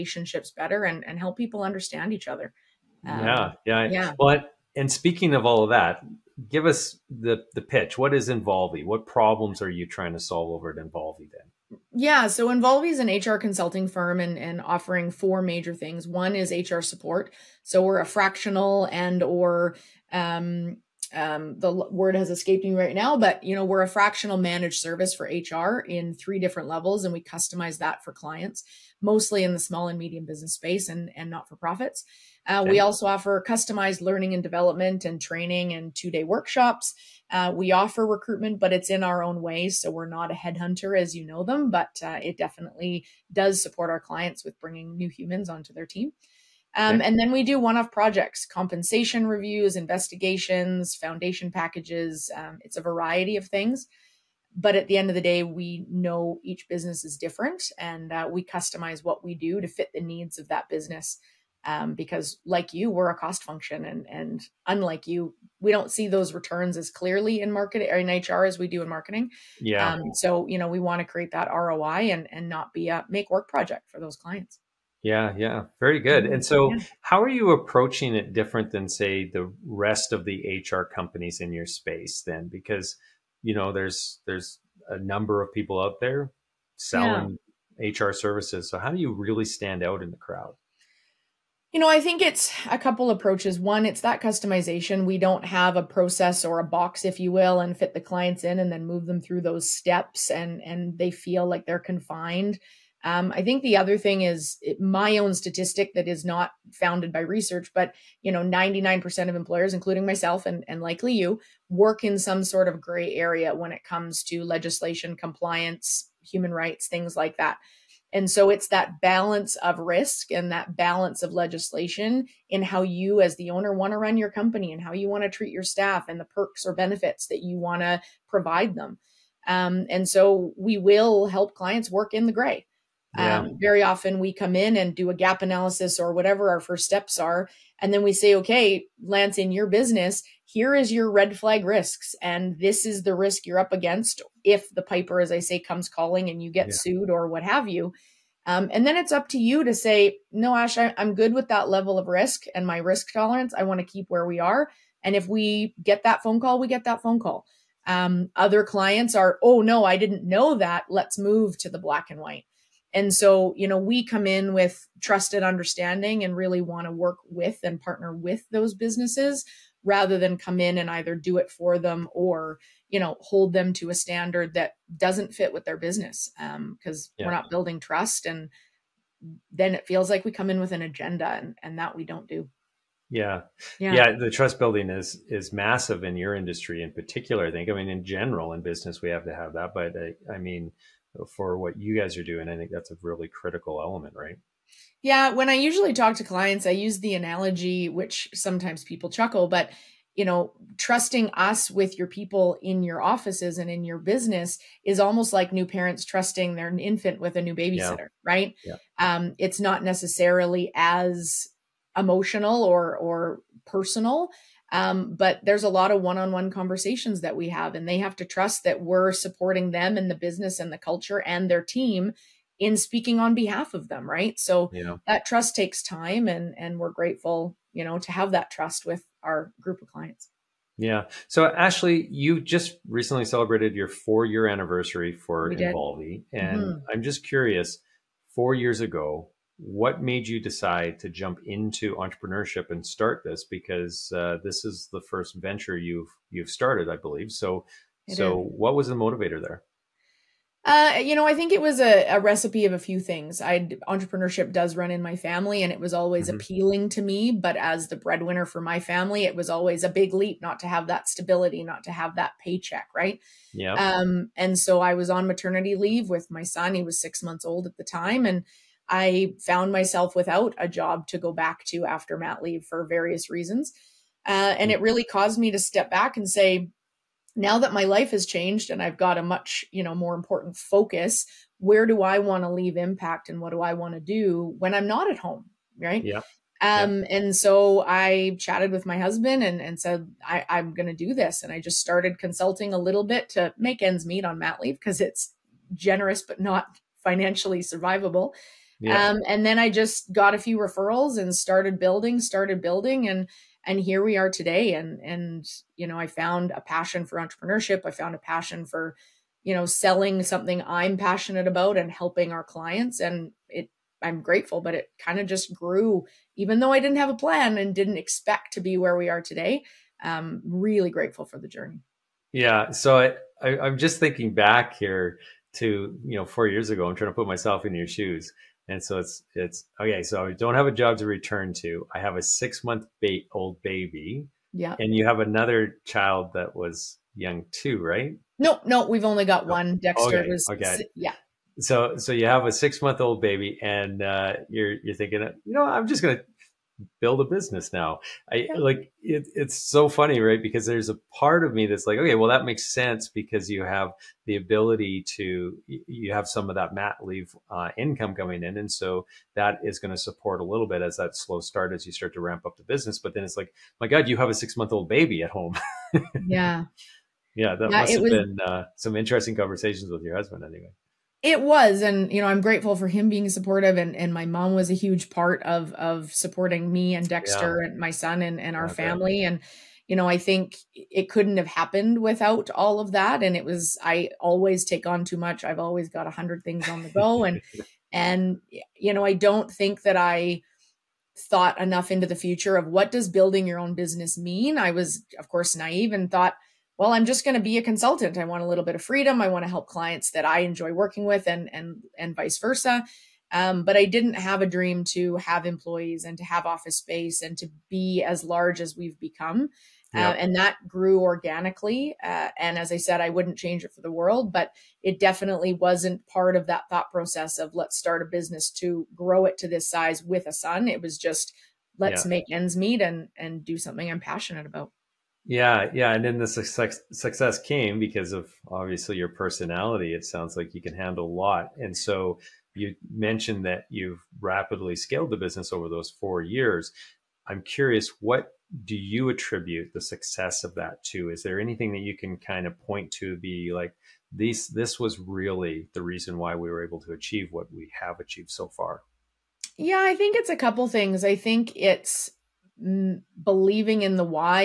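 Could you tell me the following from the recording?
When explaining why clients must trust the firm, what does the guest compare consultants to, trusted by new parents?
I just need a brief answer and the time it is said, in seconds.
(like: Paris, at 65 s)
A new babysitter, at 207 s.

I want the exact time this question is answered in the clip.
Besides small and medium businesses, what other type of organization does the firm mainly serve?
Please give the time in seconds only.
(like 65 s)
31 s.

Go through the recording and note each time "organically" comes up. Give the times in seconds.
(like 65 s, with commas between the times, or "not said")
410 s.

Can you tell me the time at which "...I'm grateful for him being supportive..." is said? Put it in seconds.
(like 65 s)
372 s.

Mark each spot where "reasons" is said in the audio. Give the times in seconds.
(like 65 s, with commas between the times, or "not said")
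273 s, 445 s.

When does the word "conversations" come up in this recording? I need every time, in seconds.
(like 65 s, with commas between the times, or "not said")
216 s, 369 s.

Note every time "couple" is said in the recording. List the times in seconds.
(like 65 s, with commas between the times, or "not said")
92 s, 450 s.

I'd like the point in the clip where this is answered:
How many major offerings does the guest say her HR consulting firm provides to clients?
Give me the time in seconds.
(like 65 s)
15 s.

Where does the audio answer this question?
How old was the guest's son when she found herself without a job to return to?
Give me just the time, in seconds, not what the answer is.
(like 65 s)
267 s.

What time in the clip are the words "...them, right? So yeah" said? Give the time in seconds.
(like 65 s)
223 s.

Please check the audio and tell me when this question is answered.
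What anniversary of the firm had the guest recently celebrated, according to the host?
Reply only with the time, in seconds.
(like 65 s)
233 s.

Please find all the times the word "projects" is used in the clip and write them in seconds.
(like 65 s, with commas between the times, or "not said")
47 s, 73 s.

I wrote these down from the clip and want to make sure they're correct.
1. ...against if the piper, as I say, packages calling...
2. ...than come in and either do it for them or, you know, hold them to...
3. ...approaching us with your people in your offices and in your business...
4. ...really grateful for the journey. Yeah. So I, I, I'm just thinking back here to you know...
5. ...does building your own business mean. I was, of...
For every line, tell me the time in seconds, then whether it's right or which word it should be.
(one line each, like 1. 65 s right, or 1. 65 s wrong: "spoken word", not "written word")
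1. 143 s wrong: "comes", not "packages"
2. 170 s right
3. 200 s wrong: "trusting", not "approaching"
4. 320 s right
5. 392 s right.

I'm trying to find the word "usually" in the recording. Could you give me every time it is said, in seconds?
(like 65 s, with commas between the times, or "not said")
195 s.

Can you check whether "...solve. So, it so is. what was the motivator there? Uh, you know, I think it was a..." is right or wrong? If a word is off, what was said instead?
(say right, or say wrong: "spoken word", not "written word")
wrong: "believe", not "solve".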